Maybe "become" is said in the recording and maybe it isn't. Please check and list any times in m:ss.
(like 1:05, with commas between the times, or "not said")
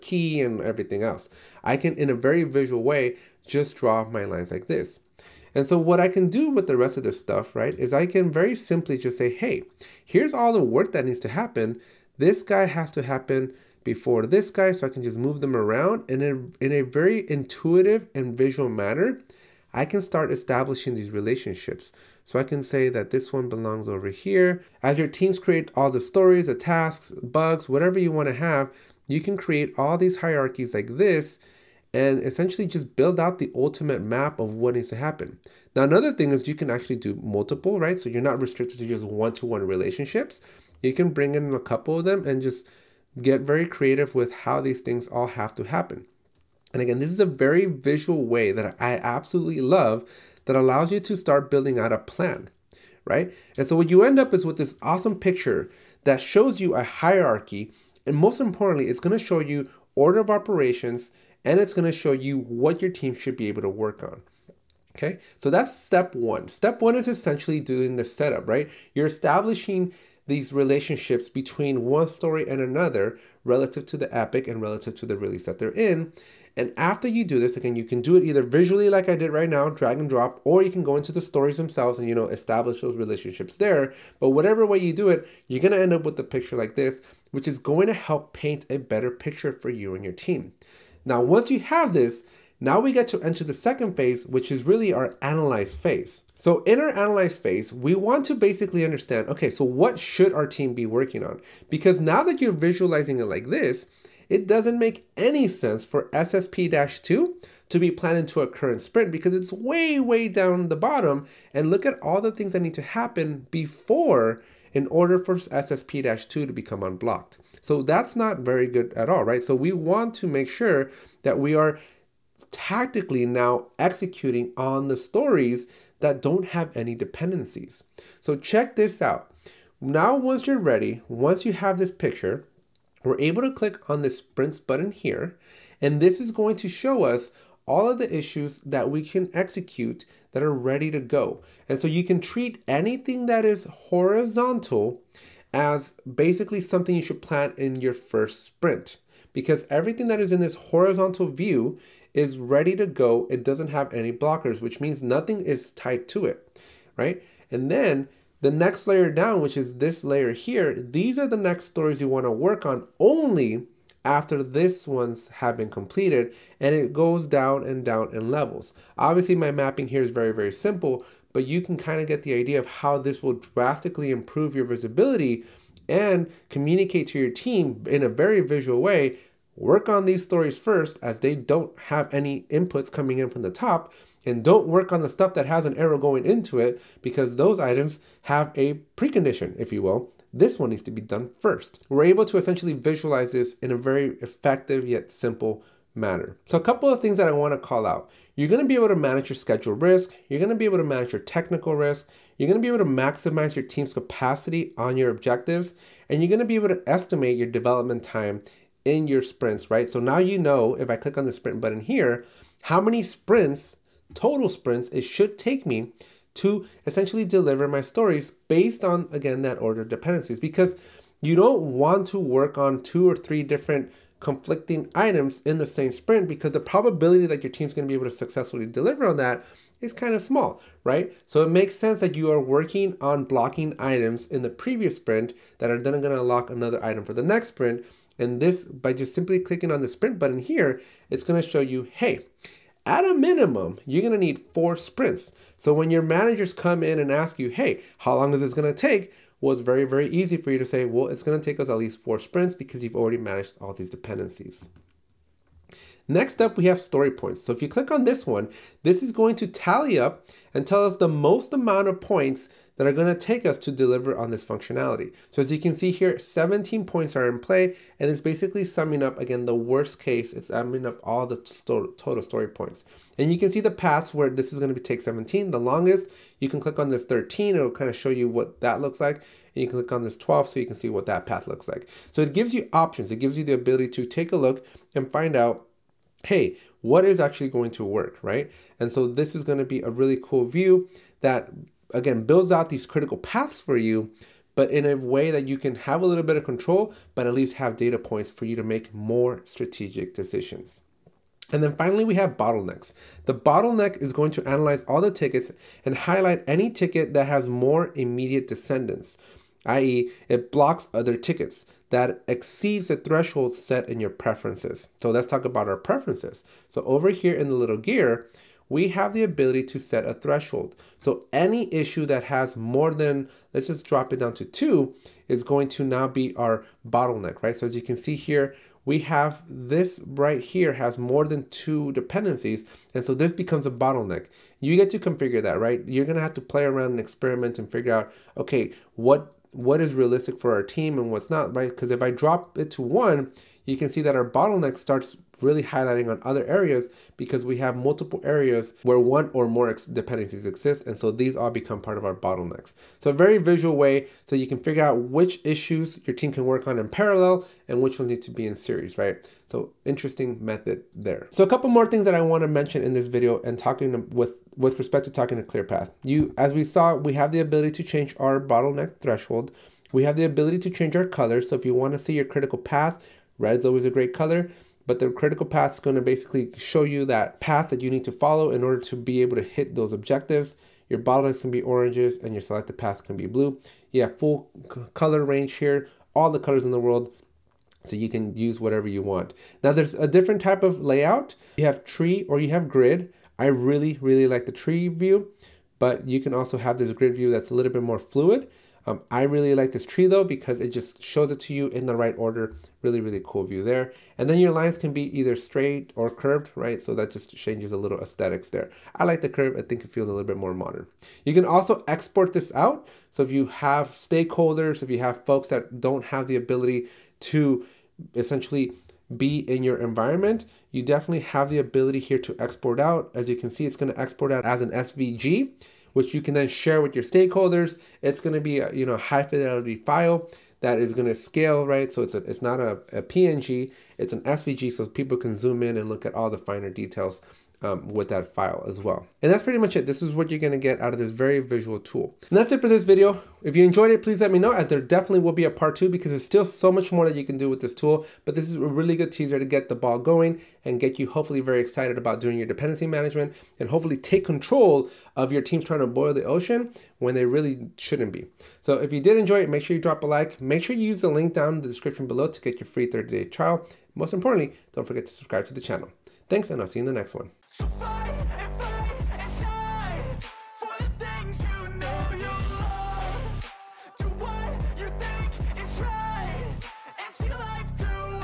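1:56, 5:33, 5:51.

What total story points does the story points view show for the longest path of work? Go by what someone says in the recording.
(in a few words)
17.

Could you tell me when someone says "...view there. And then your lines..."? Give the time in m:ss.
6:43.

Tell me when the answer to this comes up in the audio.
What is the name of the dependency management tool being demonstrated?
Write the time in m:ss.
6:05.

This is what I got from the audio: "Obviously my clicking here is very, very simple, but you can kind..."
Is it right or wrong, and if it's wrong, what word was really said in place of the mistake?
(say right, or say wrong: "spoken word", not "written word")
wrong: "mapping", not "clicking".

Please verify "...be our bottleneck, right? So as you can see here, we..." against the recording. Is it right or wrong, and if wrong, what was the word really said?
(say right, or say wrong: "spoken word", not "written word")
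right.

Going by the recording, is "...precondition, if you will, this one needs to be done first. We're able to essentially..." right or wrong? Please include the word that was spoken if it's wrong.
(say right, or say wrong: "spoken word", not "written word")
right.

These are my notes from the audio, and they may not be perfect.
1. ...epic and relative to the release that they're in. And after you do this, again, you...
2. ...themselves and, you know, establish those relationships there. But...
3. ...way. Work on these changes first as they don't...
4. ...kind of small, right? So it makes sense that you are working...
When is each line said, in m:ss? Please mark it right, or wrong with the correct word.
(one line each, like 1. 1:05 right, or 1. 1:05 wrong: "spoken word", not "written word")
1. 1:14 right
2. 1:21 right
3. 2:58 wrong: "stories", not "changes"
4. 3:49 right.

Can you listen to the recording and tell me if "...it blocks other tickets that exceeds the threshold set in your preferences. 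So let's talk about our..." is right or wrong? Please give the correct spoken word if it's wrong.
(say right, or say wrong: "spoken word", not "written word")
right.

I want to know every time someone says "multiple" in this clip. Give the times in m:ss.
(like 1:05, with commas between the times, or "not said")
0:37, 5:47.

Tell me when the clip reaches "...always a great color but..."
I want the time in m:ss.
6:13.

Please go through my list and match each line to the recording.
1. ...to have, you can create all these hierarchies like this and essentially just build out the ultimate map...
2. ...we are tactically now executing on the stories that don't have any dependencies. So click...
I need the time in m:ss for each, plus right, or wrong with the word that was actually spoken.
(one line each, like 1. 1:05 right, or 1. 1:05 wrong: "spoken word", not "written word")
1. 0:28 right
2. 2:01 wrong: "check", not "click".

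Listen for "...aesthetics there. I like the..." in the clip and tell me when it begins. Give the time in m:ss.
6:48.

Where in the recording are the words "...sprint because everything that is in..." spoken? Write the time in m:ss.
2:28.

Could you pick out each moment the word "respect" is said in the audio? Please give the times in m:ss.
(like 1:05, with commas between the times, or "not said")
6:04.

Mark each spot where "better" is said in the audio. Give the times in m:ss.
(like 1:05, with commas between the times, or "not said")
1:28.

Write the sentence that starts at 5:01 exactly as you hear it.
And then finally, we have bottlenecks.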